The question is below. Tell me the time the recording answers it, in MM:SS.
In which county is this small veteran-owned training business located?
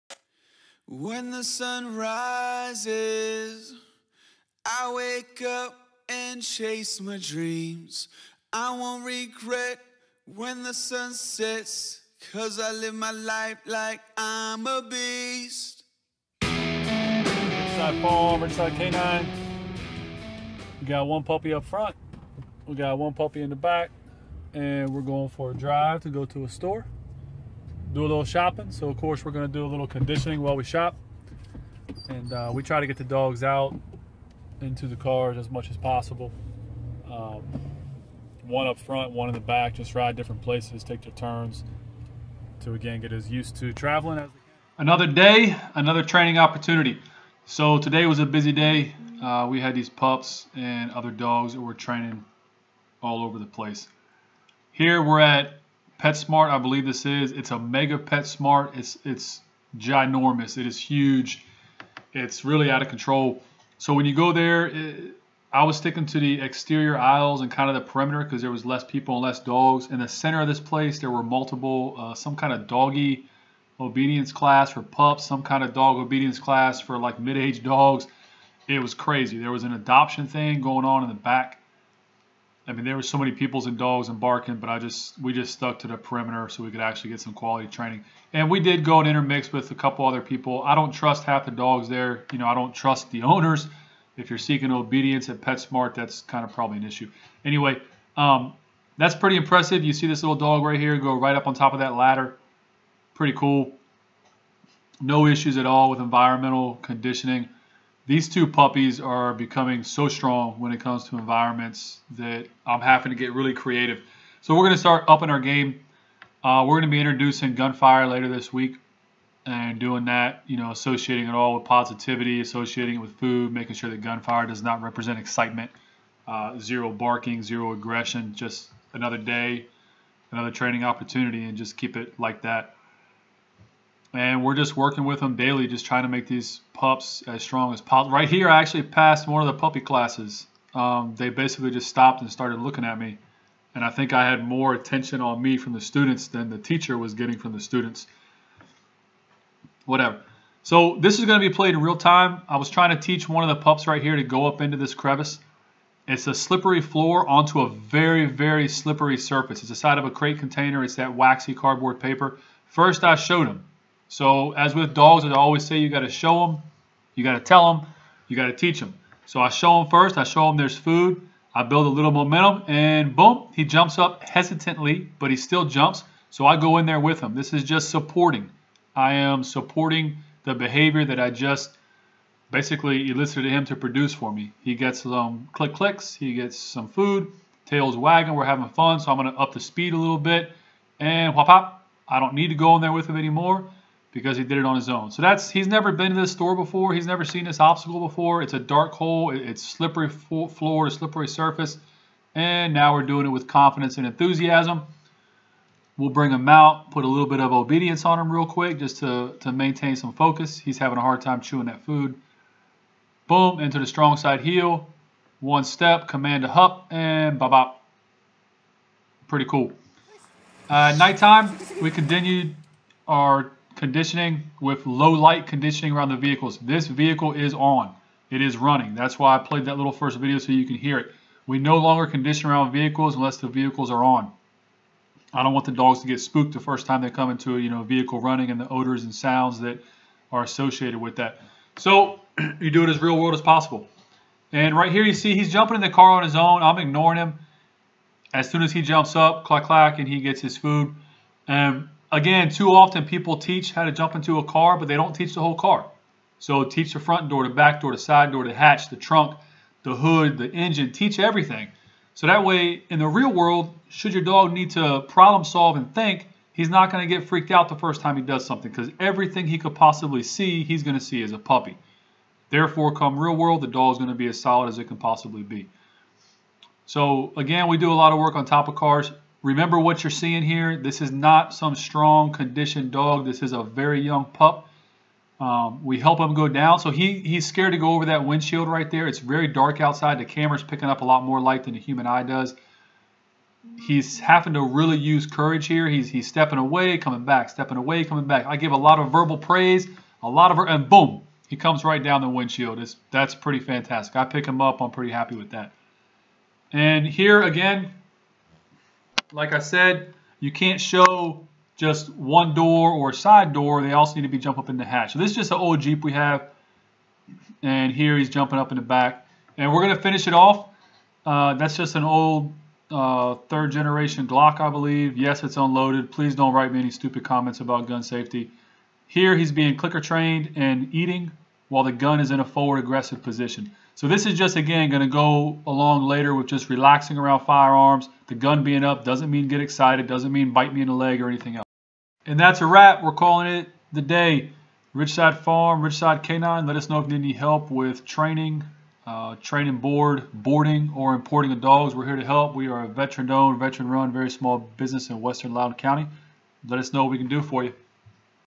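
05:55.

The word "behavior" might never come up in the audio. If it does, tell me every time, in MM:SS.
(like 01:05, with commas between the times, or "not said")
03:00.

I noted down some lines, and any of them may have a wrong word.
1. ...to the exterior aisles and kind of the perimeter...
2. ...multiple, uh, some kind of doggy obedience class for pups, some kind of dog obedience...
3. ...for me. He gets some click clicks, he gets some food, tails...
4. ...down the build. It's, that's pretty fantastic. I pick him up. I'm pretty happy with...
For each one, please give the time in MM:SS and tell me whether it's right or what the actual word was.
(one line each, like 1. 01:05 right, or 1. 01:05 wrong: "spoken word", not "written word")
1. 01:06 right
2. 01:11 right
3. 03:04 right
4. 05:02 wrong: "windshield", not "build".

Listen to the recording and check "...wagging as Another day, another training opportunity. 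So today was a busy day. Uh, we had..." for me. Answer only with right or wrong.
wrong.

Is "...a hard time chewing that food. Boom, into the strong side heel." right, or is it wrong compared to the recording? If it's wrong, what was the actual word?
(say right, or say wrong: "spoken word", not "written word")
right.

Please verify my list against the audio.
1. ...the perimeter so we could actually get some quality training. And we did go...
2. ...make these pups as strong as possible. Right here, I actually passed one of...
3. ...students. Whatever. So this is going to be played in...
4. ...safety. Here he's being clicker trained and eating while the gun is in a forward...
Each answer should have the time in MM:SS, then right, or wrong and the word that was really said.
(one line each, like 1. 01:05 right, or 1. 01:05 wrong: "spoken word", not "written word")
1. 01:25 right
2. 02:16 right
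3. 02:27 right
4. 05:28 right.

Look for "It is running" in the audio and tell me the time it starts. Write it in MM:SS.
03:48.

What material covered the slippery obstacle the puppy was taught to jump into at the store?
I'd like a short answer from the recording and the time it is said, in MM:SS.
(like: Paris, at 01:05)
Waxy cardboard paper, at 02:41.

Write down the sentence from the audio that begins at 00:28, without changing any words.
So of course we're gonna do a little conditioning while we shop.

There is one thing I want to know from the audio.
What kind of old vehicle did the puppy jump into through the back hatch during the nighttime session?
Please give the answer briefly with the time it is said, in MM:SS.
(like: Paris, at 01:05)
Jeep, at 05:15.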